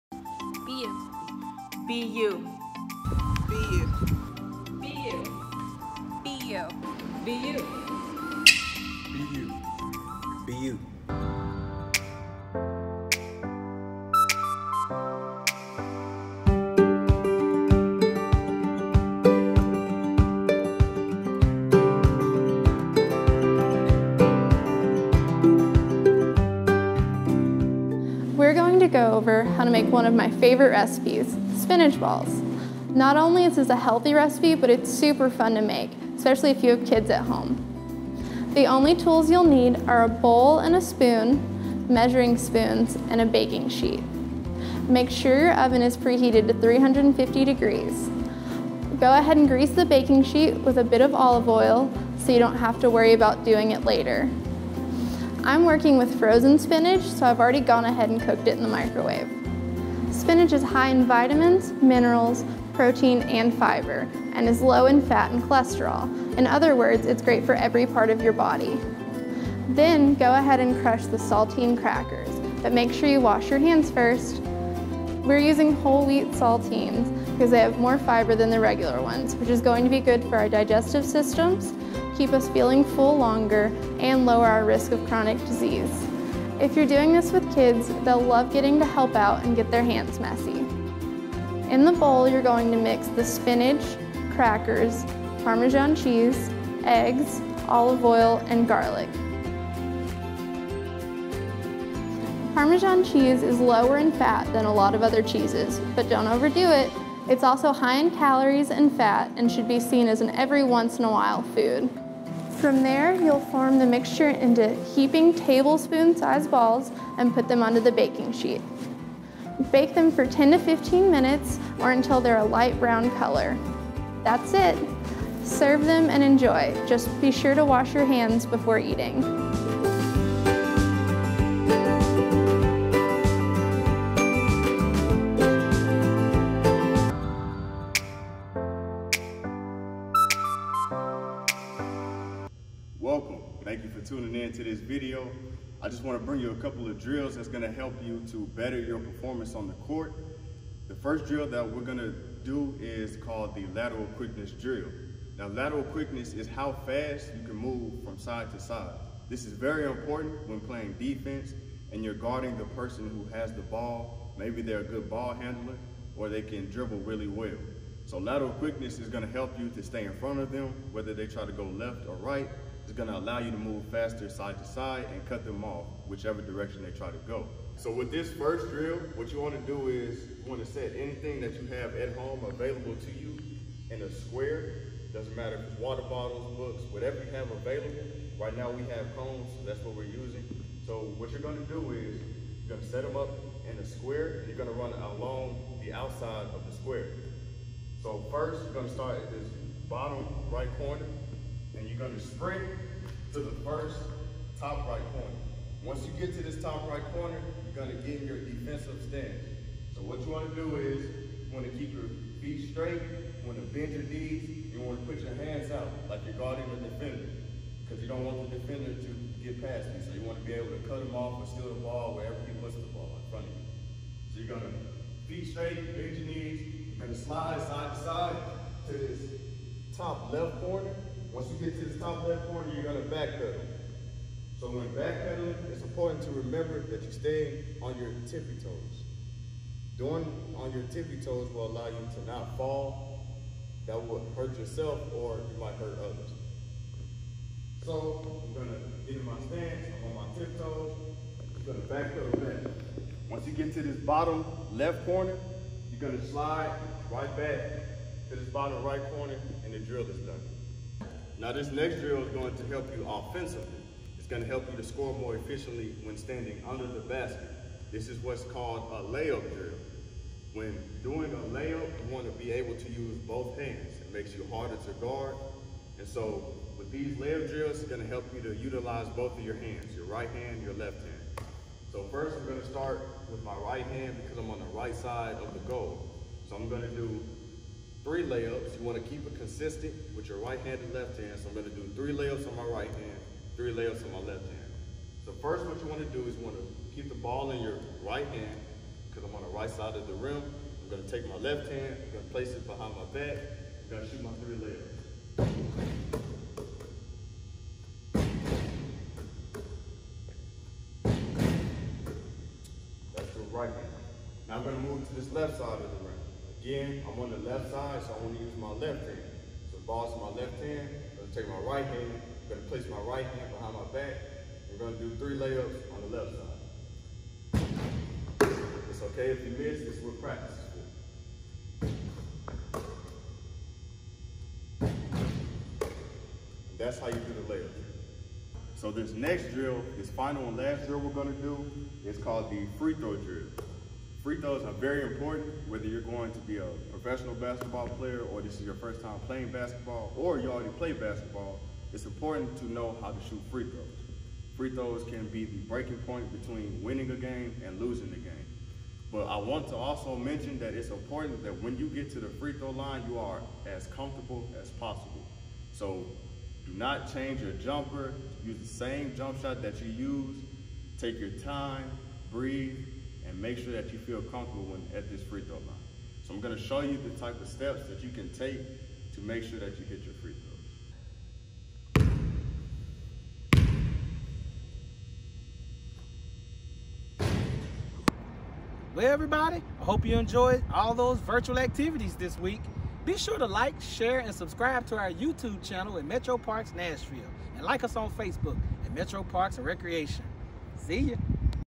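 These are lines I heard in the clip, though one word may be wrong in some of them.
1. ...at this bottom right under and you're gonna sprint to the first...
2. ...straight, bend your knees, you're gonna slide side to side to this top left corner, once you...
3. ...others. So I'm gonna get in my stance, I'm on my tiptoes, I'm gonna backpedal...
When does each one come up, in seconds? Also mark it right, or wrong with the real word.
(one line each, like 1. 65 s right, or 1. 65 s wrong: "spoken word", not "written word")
1. 199 s wrong: "corner", not "under"
2. 225 s right
3. 245 s right.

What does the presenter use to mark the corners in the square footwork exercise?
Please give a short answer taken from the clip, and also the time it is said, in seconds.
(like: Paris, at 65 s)
cones, at 189 s.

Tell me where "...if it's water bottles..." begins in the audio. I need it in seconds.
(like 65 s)
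185 s.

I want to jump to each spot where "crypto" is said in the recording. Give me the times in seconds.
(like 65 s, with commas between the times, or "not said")
not said.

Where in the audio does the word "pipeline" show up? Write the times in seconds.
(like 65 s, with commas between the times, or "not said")
not said.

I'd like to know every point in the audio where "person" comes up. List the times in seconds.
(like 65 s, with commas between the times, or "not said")
162 s.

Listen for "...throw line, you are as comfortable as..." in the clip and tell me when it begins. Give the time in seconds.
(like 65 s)
362 s.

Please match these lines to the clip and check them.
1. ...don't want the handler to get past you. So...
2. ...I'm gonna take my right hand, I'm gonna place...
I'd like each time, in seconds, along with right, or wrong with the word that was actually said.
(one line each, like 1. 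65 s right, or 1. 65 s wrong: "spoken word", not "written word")
1. 218 s wrong: "defender", not "handler"
2. 321 s right.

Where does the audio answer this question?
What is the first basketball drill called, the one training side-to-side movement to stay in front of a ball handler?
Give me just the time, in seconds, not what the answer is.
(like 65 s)
153 s.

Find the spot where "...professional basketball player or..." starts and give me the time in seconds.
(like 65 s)
346 s.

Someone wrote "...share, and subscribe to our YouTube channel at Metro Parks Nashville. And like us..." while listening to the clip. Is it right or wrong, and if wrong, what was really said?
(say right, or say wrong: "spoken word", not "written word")
right.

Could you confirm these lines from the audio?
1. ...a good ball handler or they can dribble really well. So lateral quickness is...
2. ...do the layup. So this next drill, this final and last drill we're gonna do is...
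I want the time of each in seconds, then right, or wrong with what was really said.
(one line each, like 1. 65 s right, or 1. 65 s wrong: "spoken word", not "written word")
1. 164 s right
2. 337 s right.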